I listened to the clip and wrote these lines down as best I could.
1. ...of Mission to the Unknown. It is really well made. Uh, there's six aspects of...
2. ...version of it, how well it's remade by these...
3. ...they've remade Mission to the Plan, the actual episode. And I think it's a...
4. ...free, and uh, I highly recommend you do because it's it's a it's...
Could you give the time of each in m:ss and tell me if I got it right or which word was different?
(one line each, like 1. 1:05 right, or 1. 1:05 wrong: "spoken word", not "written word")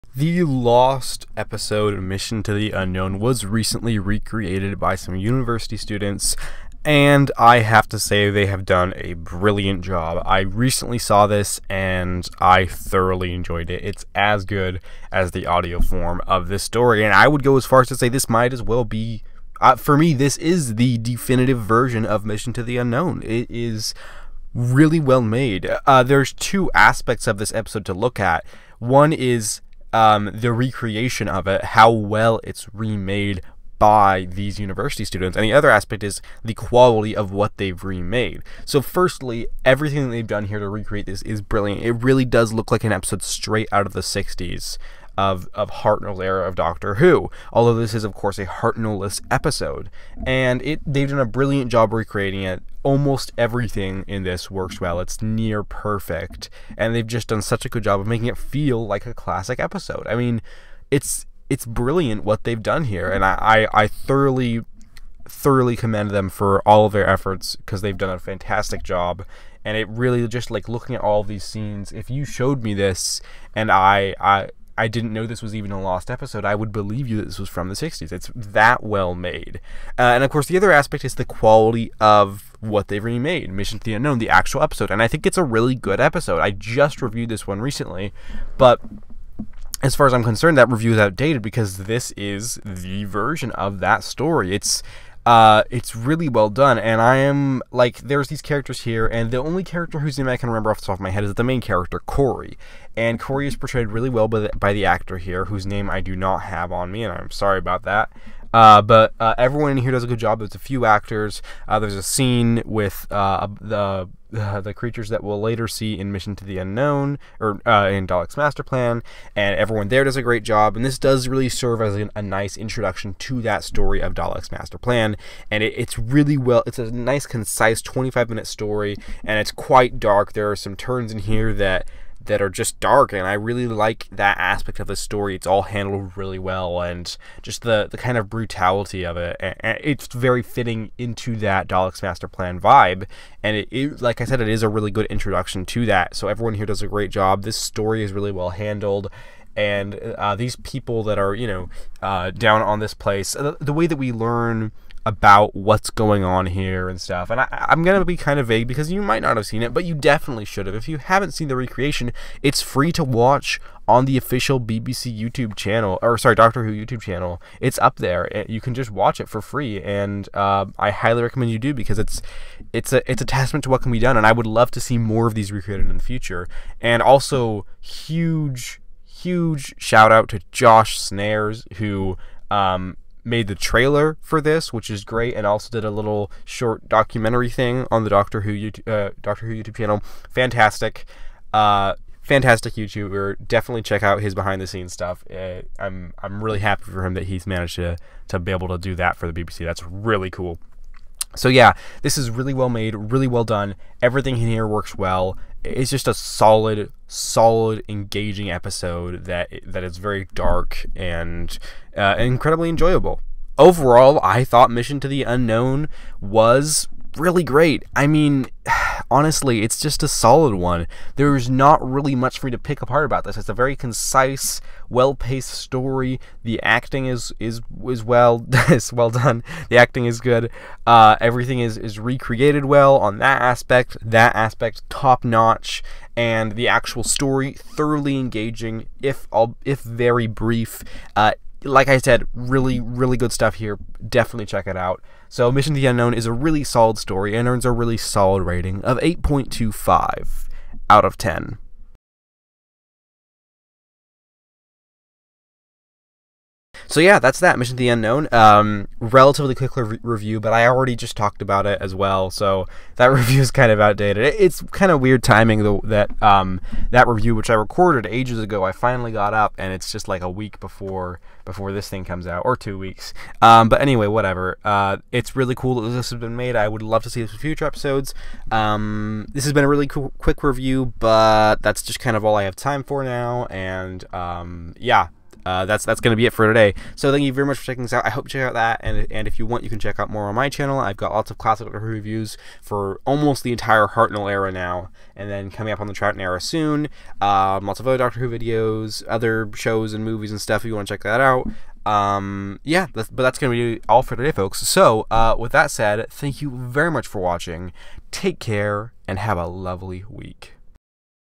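1. 0:22 wrong: "two", not "six"
2. 0:30 wrong: "recreation", not "version"
3. 1:22 wrong: "Unknown", not "Plan"
4. 2:49 right.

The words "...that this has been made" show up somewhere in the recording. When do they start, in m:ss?
4:35.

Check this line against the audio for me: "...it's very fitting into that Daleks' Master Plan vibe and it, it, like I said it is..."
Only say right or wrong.
right.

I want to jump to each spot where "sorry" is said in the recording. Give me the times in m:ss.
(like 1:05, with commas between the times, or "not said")
1:47, 2:46.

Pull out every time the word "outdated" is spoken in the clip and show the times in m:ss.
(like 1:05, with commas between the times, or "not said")
1:30, 4:23.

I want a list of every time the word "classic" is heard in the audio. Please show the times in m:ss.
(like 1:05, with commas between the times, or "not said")
0:59, 4:51.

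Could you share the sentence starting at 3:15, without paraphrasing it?
Uh, I'm I'm really happy for him that he's managed to to be able to do that for the BBC.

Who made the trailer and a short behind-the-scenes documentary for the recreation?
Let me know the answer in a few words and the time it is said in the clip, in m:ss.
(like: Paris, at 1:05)
Josh Snares, at 3:00.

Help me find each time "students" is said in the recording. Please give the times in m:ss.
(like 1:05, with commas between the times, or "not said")
0:05, 0:35.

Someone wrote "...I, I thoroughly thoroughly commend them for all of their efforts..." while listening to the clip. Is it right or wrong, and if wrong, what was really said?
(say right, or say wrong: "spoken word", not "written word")
right.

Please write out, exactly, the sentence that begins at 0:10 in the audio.
I recently saw this and I thoroughly enjoyed it.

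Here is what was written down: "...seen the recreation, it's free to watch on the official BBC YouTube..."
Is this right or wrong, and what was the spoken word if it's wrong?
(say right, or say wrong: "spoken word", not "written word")
right.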